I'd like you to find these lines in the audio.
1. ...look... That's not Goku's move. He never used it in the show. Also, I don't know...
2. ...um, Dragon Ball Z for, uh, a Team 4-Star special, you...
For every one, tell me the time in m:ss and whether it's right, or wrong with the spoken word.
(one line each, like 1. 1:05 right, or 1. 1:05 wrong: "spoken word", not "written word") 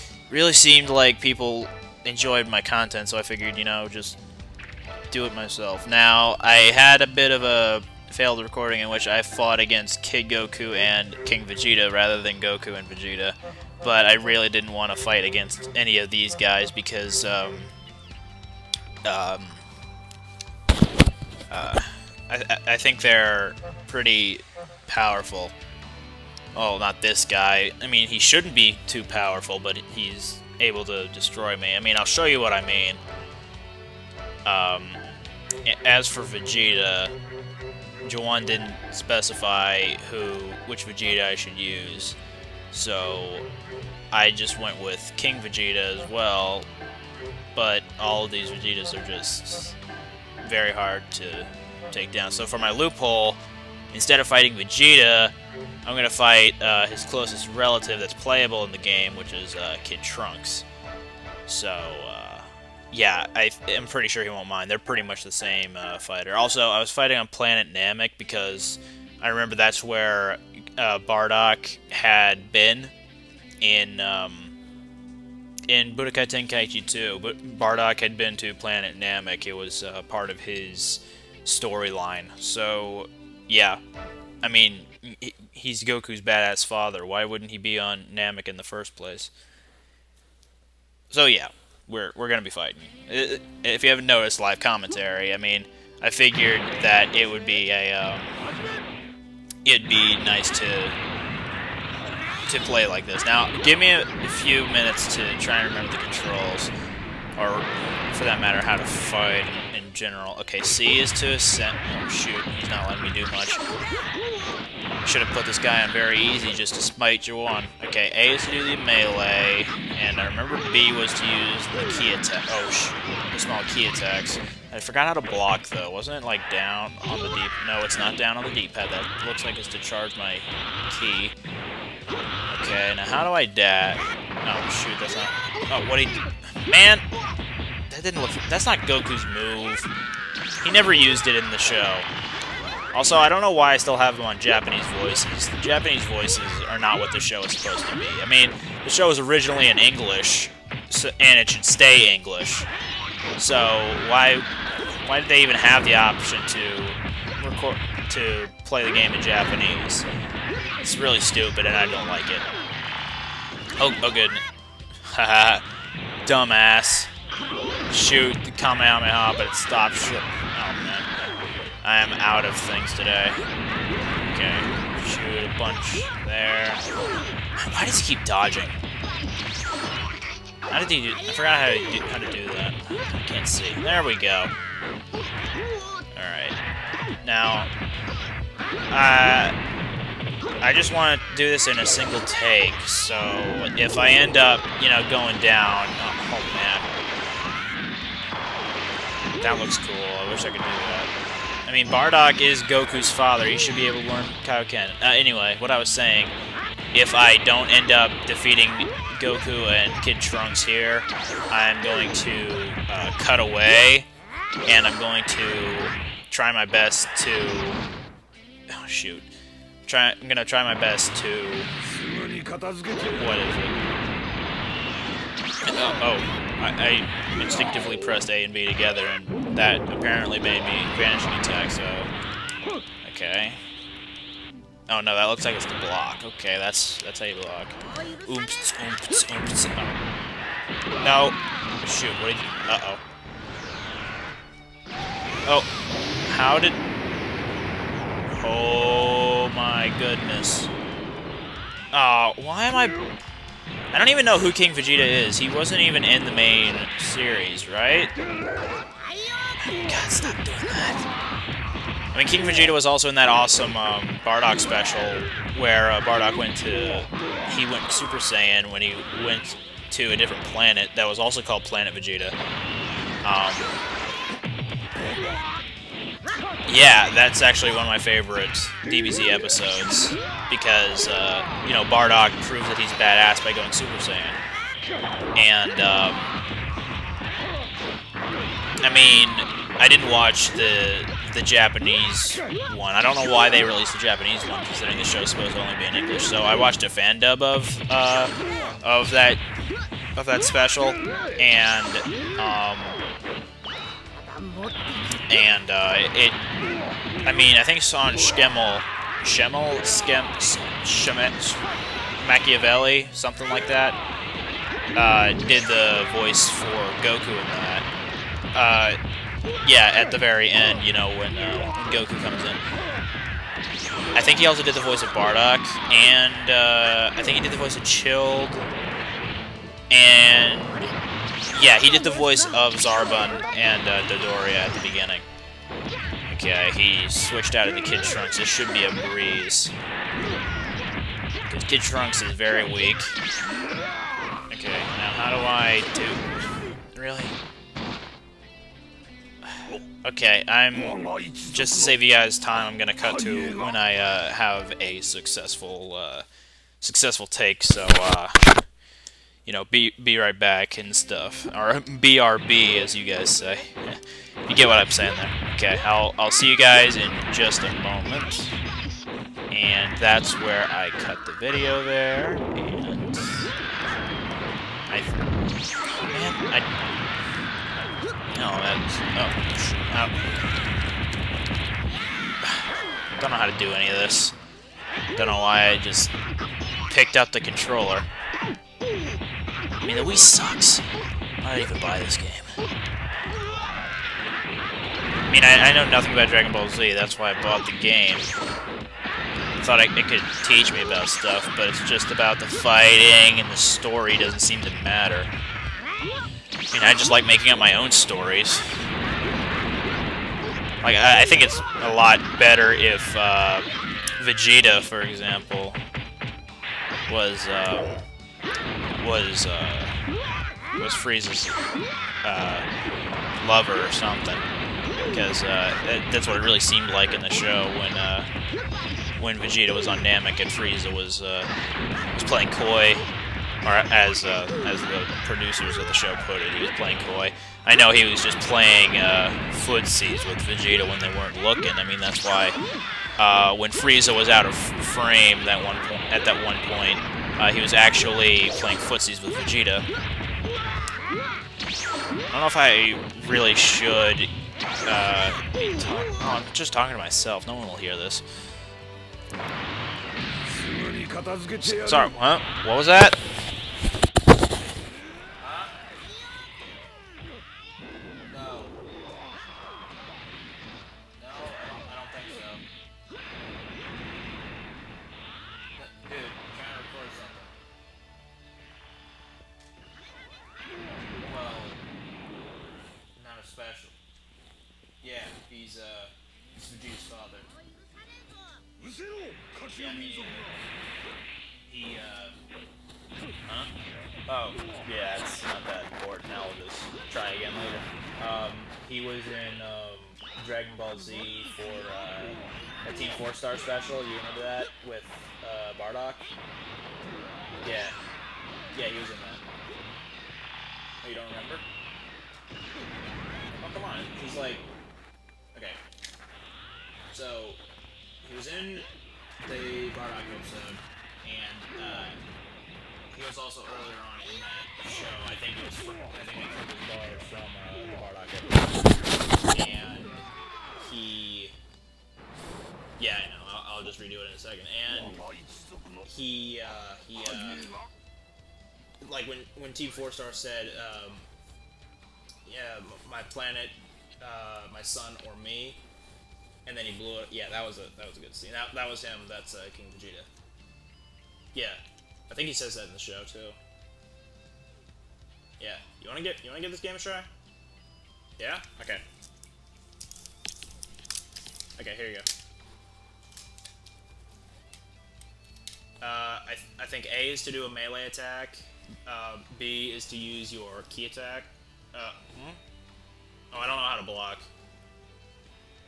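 1. 2:18 right
2. 8:19 right.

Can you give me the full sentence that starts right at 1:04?
They're pretty much the same uh, fighter.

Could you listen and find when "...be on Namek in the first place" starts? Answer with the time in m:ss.
1:27.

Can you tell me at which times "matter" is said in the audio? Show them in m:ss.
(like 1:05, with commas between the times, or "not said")
1:48, 6:44.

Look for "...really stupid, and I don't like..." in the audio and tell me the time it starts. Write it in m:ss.
2:40.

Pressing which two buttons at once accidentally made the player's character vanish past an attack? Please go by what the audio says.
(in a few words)
A and B.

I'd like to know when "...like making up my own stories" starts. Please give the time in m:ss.
6:47.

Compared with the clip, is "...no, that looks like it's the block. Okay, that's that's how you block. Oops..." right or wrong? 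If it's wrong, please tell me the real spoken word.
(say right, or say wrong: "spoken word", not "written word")
right.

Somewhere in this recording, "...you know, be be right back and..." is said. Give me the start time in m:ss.
5:59.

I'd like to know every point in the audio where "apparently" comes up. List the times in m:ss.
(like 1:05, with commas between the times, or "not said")
3:49.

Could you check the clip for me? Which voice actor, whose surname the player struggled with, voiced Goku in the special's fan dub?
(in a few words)
Sean Schemmel.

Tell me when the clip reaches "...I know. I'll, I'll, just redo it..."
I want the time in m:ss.
8:53.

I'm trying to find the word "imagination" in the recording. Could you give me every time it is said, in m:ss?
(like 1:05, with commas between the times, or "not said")
not said.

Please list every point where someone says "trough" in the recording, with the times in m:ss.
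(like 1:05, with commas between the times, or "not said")
not said.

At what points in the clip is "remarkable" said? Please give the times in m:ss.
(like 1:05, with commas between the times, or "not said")
not said.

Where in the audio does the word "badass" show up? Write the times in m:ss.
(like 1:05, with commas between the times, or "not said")
1:26, 4:42.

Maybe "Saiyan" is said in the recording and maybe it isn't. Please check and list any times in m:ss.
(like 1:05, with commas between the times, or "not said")
4:28, 4:43.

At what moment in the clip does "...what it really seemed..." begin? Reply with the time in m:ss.
7:06.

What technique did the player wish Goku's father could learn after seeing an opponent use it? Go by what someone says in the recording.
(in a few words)
Kaioken.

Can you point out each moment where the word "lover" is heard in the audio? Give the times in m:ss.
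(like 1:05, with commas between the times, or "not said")
7:03.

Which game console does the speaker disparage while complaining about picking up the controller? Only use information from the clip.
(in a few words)
Wii.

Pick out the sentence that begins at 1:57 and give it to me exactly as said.
Okay, A is to do the melee, and I remember B was to use the ki attack.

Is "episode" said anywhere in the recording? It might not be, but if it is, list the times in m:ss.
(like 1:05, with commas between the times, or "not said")
4:39, 8:40, 8:49.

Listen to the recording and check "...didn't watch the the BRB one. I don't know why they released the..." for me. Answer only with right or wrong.
wrong.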